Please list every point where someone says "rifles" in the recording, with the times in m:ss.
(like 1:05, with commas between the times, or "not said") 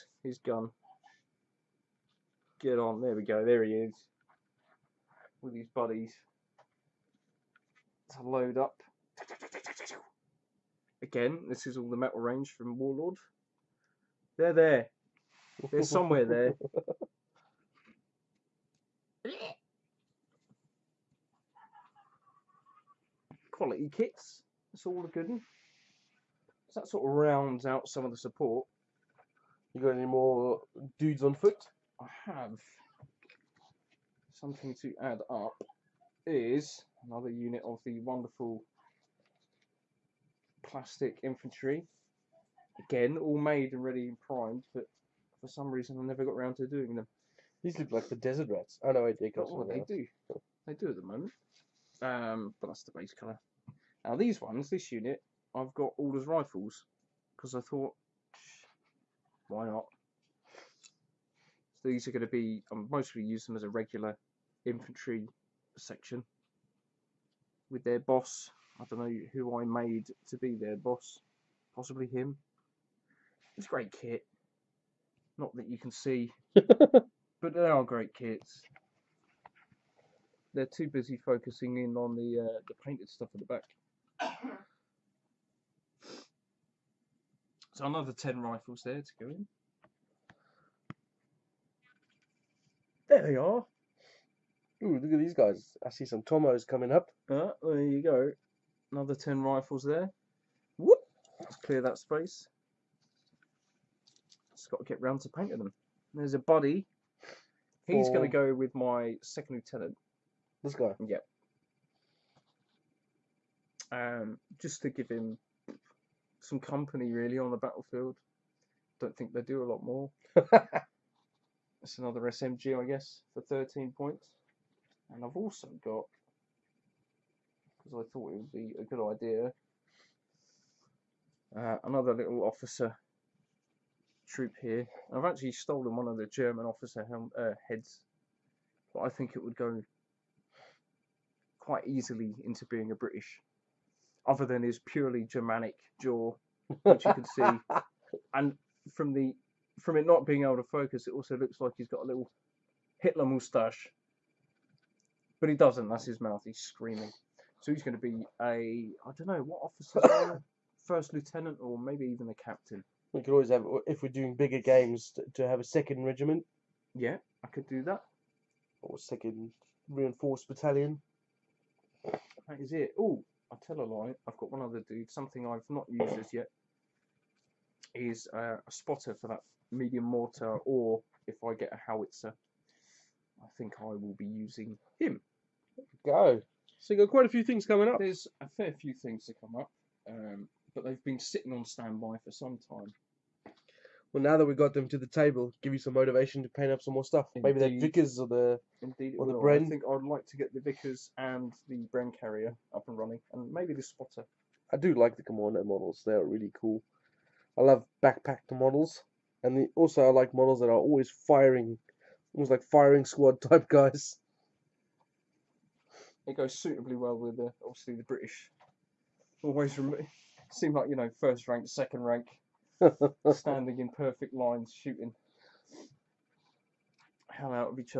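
0:56, 1:28, 1:39.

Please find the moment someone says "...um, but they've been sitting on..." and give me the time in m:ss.
3:10.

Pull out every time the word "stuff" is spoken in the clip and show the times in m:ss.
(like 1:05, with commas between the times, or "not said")
1:23, 3:17.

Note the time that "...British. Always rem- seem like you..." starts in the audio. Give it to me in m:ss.
3:38.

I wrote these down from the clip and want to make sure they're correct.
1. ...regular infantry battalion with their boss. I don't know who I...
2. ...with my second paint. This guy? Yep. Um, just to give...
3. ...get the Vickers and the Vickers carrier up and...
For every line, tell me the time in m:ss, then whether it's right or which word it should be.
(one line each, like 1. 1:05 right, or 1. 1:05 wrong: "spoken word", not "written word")
1. 1:03 wrong: "section", not "battalion"
2. 1:48 wrong: "lieutenant", not "paint"
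3. 3:20 wrong: "Bren", not "Vickers".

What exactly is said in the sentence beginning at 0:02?
Get on, there we go, there he is with his buddies to load up.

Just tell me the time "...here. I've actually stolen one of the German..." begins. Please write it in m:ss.
2:14.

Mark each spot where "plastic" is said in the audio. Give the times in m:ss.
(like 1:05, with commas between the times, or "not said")
0:40.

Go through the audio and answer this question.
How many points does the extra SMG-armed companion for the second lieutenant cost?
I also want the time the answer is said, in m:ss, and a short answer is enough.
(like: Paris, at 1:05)
13, at 2:03.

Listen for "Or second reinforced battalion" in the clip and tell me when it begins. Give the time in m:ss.
2:48.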